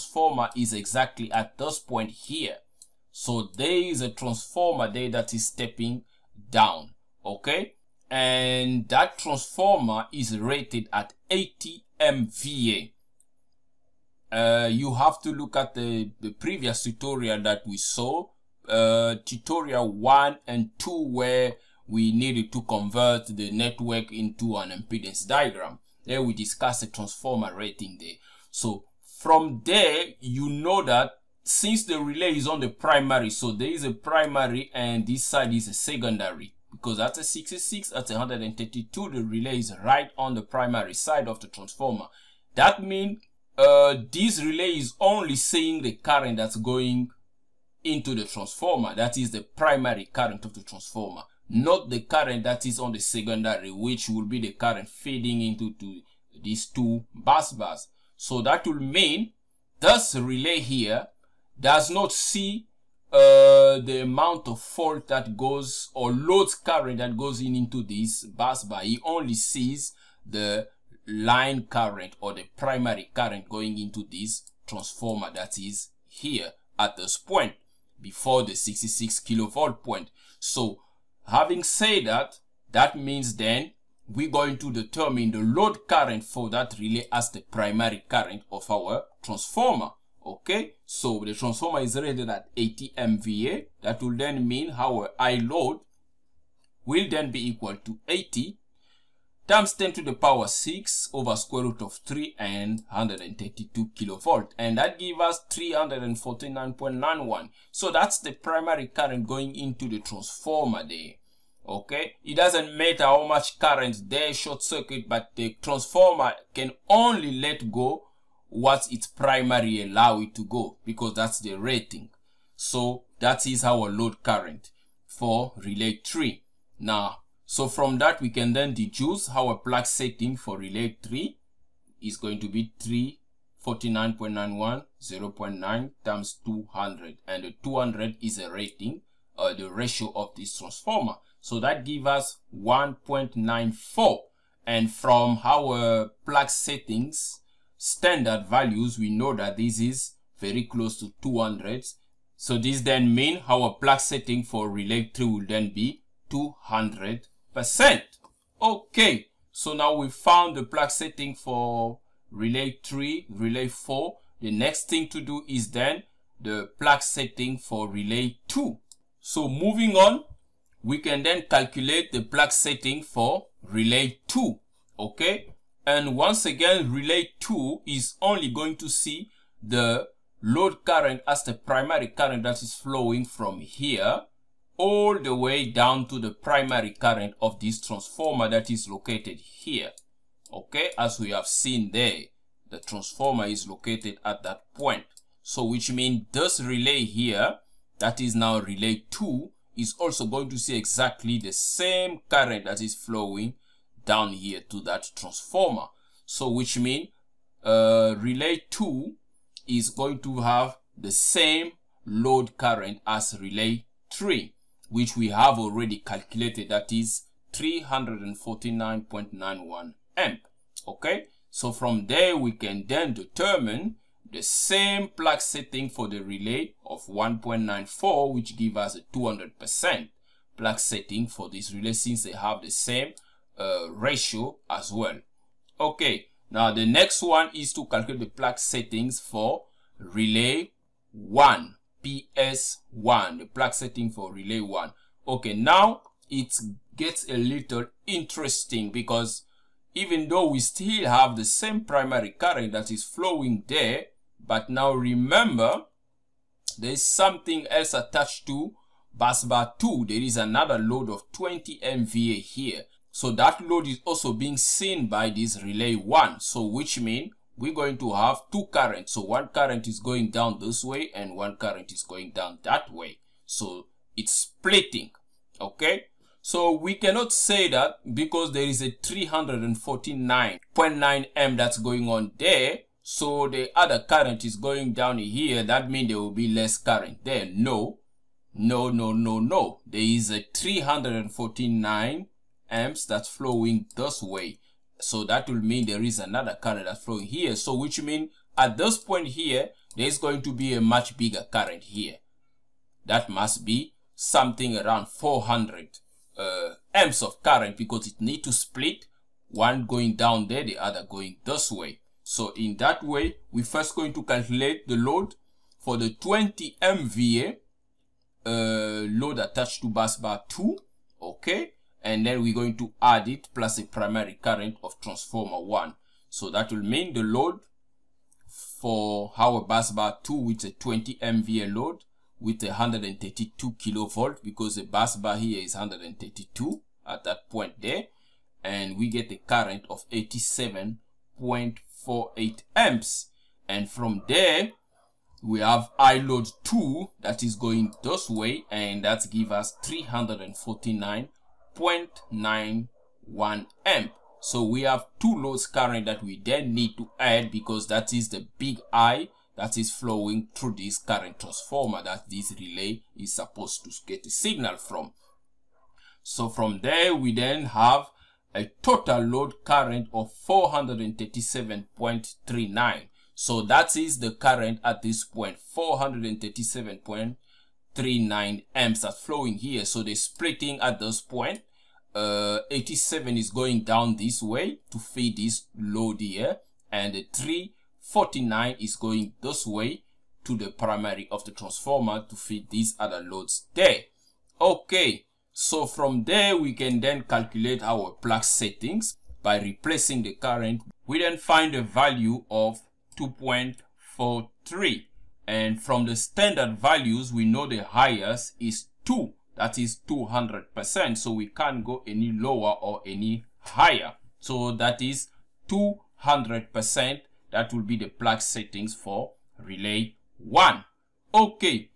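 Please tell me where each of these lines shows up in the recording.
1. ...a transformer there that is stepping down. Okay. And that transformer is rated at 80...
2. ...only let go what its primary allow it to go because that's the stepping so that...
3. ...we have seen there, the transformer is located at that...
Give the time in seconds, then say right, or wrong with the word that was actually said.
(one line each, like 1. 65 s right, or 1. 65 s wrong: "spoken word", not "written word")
1. 4 s right
2. 116 s wrong: "rating", not "stepping"
3. 191 s right.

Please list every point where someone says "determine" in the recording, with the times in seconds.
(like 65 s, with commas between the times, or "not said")
84 s, 223 s.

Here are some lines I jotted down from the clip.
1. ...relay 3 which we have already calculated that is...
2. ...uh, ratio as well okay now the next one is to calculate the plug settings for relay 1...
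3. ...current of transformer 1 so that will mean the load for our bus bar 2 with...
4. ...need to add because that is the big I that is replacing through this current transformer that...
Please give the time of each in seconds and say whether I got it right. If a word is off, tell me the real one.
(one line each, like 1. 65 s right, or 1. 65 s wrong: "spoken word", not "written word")
1. 213 s right
2. 233 s right
3. 324 s right
4. 356 s wrong: "flowing", not "replacing".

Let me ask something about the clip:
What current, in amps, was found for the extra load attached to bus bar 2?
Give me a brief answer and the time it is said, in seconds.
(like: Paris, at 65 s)
87.48 amps, at 340 s.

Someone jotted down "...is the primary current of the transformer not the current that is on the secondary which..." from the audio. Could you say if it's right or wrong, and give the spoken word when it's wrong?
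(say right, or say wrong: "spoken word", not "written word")
right.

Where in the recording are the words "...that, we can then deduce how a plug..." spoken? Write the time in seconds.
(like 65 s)
127 s.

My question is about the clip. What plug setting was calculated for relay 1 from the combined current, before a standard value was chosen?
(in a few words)
2.43.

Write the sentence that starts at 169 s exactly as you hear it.
So moving on, we can then calculate the plug setting for relay 2.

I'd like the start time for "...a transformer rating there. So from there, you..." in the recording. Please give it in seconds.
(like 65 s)
26 s.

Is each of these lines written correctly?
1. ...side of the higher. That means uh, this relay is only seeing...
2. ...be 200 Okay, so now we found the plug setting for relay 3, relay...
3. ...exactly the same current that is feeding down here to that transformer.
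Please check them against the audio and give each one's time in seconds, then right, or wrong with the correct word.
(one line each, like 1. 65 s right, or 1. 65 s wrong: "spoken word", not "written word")
1. 40 s wrong: "transformer", not "higher"
2. 155 s right
3. 200 s wrong: "flowing", not "feeding".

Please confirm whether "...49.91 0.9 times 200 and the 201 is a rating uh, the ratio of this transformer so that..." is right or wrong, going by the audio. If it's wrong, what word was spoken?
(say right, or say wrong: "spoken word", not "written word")
wrong: "200", not "201".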